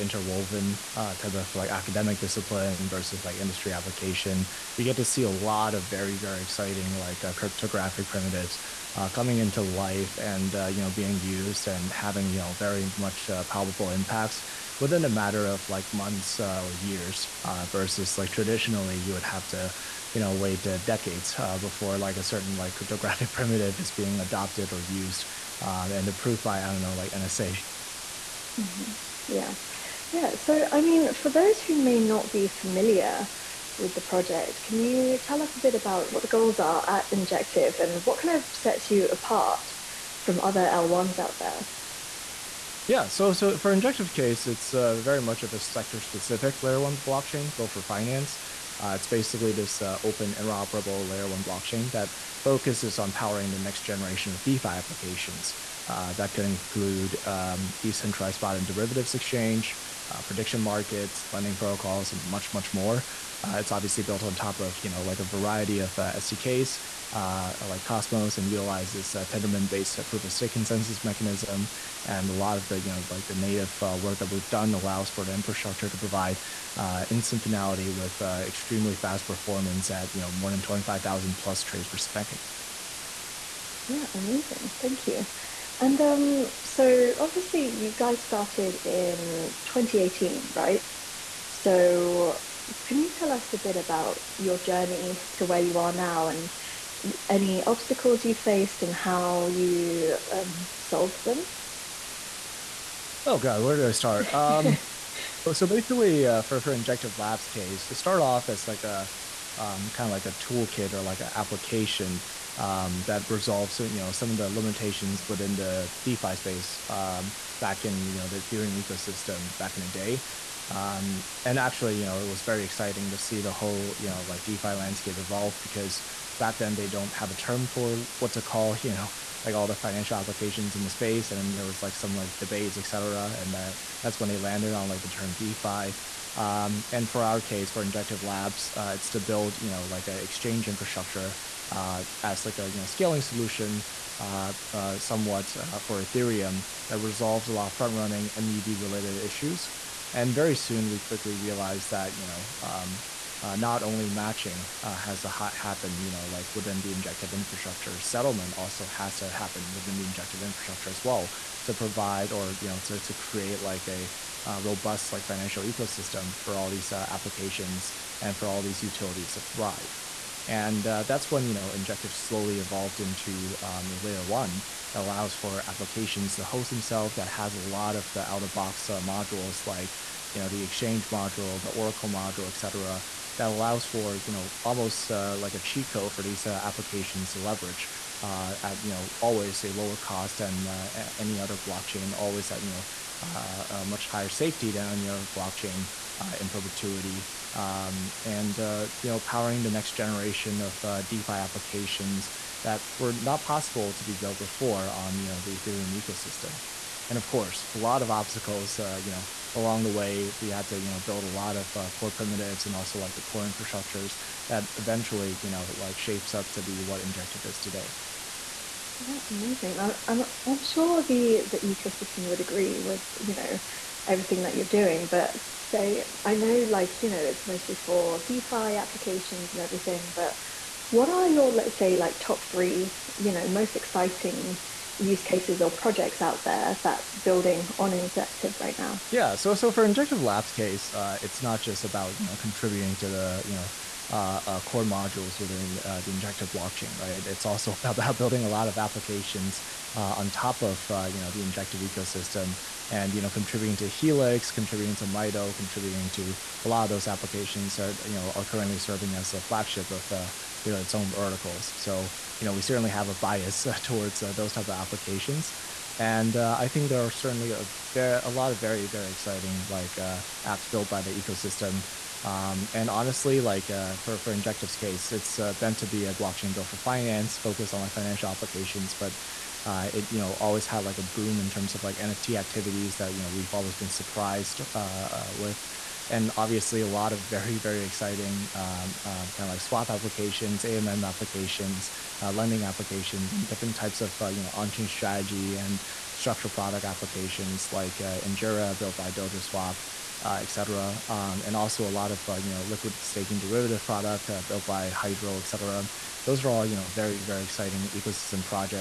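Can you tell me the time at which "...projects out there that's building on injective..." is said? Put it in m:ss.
3:55.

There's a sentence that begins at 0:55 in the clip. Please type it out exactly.
Uh, that could include um, decentralized spot and derivatives exchange, uh, prediction markets, lending protocols, and much, much more.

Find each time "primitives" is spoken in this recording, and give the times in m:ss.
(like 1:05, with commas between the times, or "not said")
0:08, 0:23, 3:32.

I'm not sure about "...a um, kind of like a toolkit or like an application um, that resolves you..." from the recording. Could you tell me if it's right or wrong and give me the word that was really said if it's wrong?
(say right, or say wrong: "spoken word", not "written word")
right.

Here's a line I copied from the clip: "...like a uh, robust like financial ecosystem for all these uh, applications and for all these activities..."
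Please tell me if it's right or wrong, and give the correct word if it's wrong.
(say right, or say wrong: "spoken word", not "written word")
wrong: "utilities", not "activities".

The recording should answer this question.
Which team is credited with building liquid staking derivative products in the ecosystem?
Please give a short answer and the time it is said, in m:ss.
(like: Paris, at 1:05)
Hydro, at 5:04.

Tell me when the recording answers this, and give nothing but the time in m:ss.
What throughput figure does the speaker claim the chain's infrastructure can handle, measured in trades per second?
1:20.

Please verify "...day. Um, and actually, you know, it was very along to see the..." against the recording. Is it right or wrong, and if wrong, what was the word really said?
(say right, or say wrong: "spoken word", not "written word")
wrong: "exciting", not "along".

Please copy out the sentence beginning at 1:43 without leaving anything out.
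Oh God, where do I start?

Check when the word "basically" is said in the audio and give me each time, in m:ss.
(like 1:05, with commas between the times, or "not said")
0:49, 1:45.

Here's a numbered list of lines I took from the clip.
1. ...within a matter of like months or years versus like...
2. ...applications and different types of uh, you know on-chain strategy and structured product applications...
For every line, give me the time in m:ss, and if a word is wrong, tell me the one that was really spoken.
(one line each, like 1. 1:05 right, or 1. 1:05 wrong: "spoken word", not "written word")
1. 0:14 right
2. 4:52 right.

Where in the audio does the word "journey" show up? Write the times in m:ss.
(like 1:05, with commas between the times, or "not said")
1:34.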